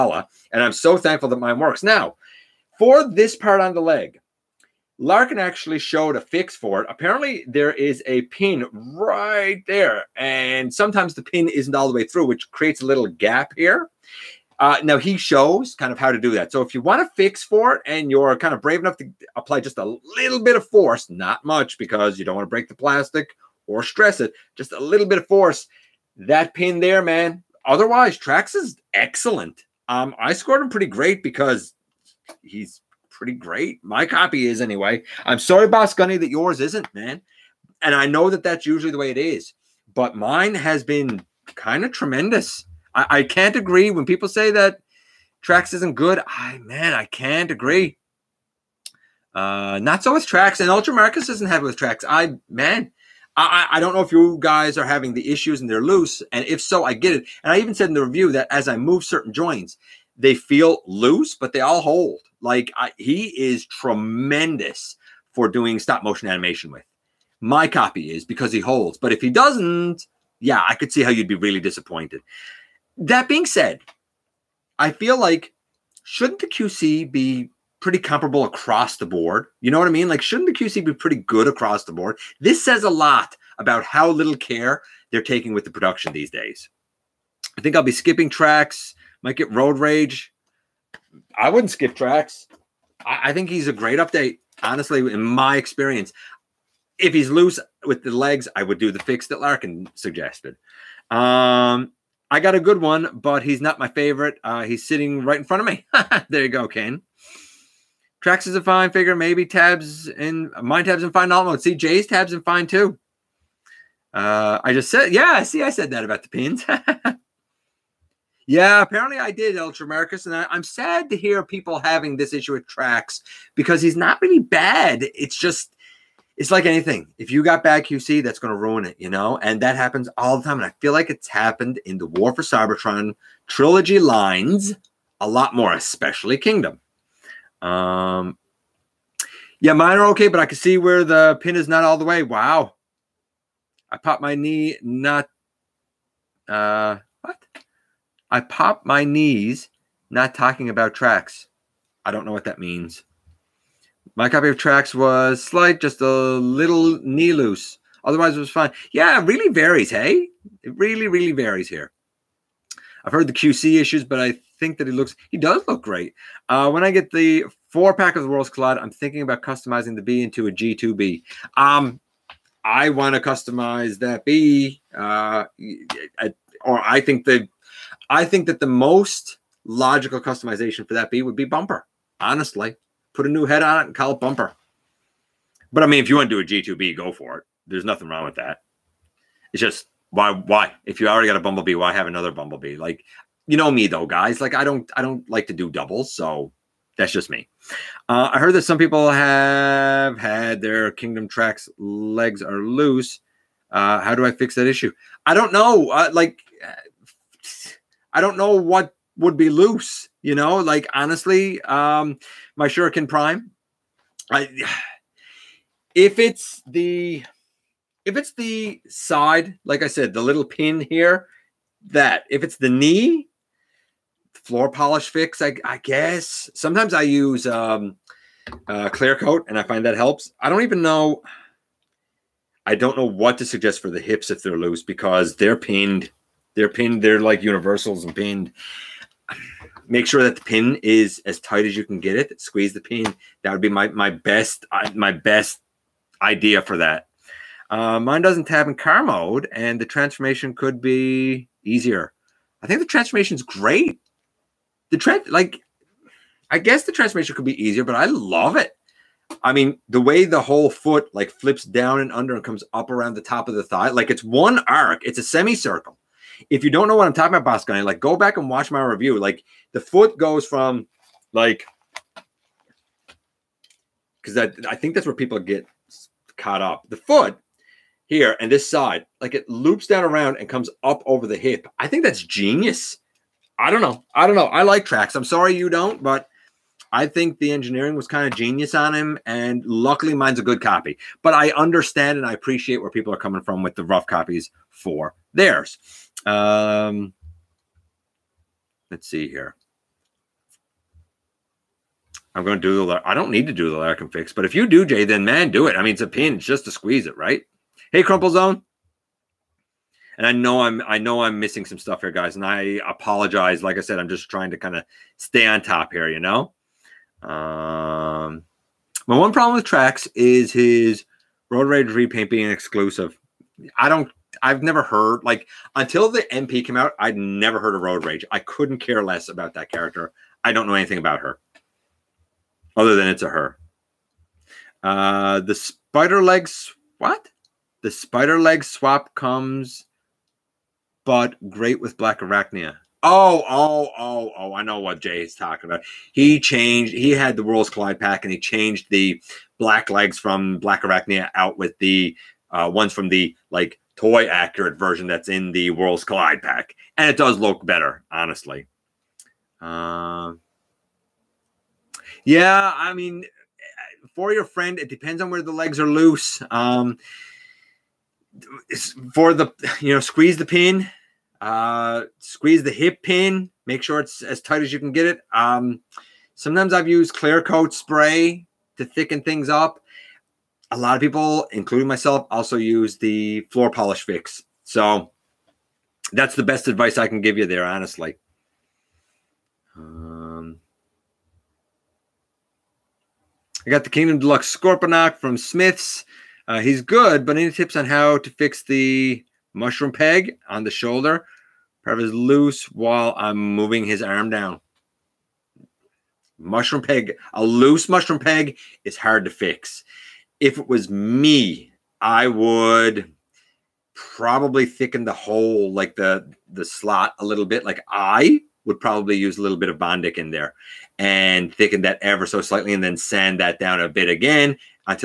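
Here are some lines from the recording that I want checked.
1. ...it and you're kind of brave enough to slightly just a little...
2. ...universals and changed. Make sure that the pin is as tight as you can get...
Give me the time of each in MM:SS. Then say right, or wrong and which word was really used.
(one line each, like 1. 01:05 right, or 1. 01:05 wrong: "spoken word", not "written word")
1. 00:17 wrong: "apply", not "slightly"
2. 03:57 wrong: "pinned", not "changed".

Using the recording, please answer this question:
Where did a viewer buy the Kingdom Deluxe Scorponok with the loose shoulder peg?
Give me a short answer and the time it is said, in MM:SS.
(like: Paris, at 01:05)
Smith's, at 06:35.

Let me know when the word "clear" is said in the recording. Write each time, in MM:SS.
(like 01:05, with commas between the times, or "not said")
03:48, 06:17.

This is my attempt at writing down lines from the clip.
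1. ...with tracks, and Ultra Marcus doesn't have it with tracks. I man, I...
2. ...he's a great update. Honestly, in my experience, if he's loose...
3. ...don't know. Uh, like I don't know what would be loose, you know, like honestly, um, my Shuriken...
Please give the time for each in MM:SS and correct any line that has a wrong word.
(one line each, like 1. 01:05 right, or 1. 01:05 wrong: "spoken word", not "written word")
1. 00:50 right
2. 01:33 right
3. 03:25 right.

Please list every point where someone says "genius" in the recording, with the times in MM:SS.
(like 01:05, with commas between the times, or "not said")
04:42, 04:48.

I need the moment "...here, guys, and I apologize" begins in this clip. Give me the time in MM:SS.
05:12.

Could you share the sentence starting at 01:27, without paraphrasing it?
I think I'll be skipping tracks, might get road rage.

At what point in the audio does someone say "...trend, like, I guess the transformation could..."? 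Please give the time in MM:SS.
04:14.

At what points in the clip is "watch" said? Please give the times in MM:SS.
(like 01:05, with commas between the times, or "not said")
04:28.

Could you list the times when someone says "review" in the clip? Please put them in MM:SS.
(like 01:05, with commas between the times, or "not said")
00:58, 04:28.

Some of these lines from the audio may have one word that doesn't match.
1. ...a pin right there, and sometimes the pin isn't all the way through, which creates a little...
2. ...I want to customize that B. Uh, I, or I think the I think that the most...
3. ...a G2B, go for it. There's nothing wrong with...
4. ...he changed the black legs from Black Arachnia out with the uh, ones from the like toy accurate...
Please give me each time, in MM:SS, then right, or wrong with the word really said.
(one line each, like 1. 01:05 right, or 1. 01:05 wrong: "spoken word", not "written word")
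1. 00:08 right
2. 02:52 right
3. 03:06 right
4. 05:48 right.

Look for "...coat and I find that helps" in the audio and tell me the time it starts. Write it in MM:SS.
03:49.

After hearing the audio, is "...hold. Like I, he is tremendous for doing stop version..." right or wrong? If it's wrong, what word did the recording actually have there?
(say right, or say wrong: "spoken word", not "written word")
wrong: "motion", not "version".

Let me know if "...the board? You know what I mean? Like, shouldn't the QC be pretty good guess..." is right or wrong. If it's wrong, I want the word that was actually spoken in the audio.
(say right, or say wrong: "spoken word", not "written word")
wrong: "across", not "guess".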